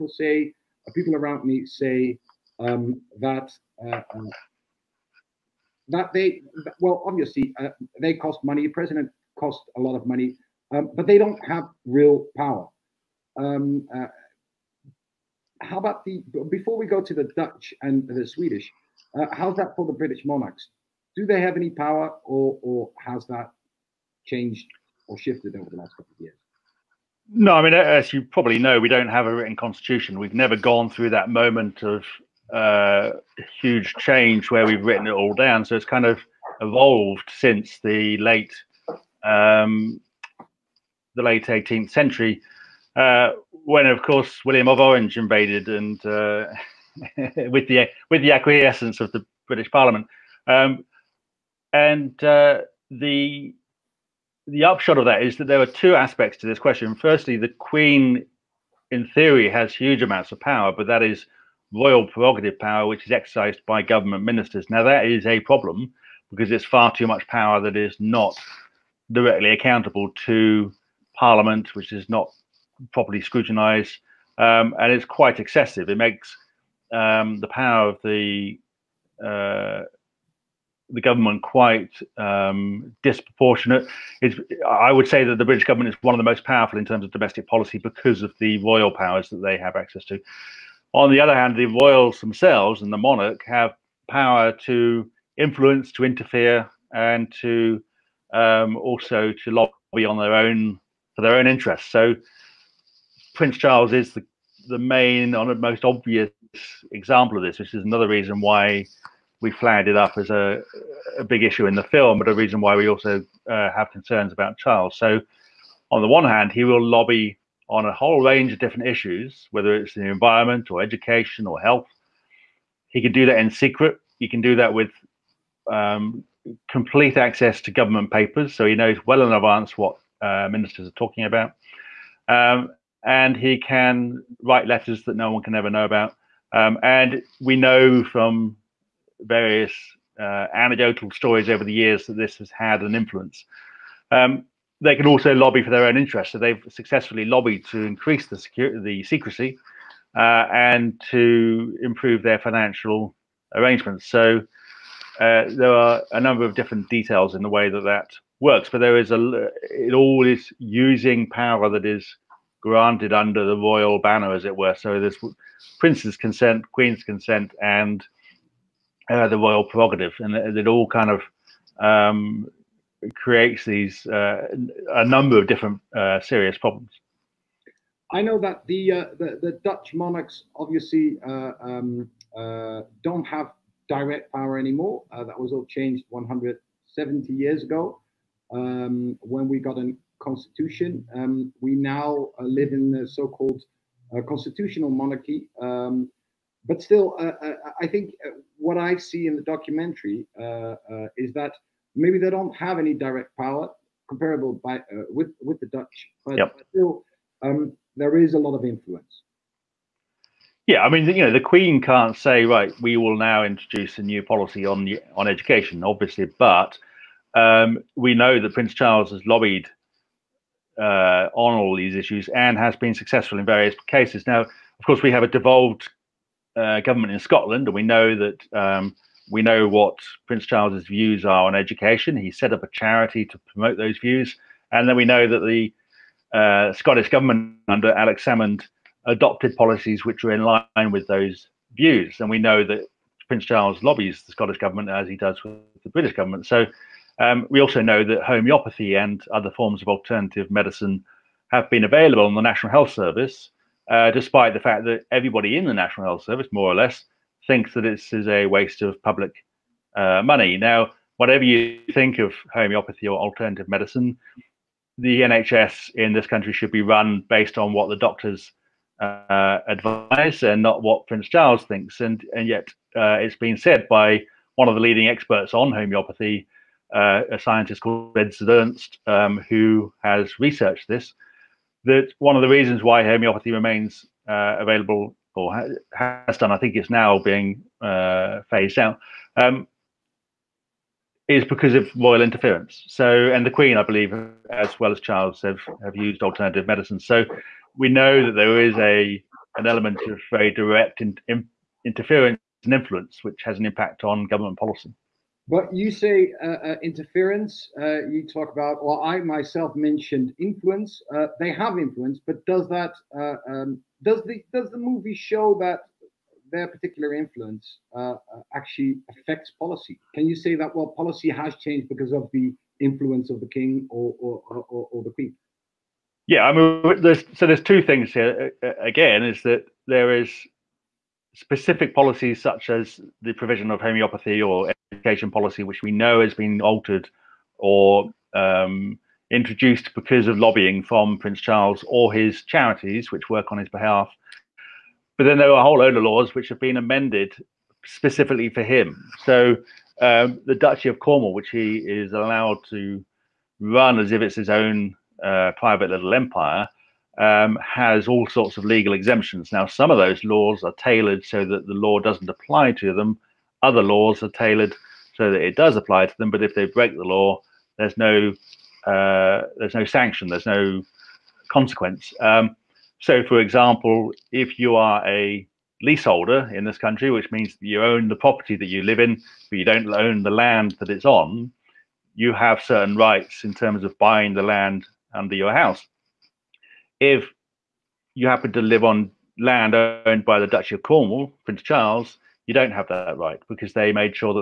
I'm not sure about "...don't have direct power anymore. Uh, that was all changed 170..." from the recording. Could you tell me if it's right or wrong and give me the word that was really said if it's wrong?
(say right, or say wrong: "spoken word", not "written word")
right.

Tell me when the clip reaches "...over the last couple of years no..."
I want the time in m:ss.
0:25.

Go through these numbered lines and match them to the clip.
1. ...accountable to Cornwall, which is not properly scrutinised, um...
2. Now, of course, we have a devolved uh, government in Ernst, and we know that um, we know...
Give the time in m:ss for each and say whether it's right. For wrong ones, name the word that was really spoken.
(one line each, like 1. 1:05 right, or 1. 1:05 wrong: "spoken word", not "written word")
1. 1:09 wrong: "Parliament", not "Cornwall"
2. 3:44 wrong: "Scotland", not "Ernst".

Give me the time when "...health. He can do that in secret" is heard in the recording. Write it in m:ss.
2:01.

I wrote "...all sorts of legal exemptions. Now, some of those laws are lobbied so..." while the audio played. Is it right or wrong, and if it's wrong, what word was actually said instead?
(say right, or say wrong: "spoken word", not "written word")
wrong: "tailored", not "lobbied".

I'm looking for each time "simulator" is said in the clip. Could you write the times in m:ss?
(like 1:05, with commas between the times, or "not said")
not said.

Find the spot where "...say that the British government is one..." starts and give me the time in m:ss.
1:25.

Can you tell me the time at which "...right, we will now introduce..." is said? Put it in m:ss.
3:32.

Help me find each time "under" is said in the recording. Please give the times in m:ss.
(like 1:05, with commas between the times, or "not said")
2:43, 3:57, 6:25.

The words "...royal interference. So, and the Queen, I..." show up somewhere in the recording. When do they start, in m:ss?
4:51.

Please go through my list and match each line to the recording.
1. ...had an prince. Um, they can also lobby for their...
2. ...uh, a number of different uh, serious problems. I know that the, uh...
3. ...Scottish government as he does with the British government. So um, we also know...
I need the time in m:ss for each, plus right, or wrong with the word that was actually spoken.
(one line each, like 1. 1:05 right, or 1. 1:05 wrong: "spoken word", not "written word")
1. 2:22 wrong: "influence", not "prince"
2. 2:54 right
3. 4:04 right.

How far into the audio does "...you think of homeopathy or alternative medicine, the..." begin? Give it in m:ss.
4:21.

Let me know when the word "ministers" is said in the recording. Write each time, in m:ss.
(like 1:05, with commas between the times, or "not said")
1:04, 2:10.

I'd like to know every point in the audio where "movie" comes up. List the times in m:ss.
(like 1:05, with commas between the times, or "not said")
5:14.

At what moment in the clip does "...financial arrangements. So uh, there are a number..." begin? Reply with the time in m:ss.
2:32.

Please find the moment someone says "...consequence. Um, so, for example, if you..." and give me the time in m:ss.
6:11.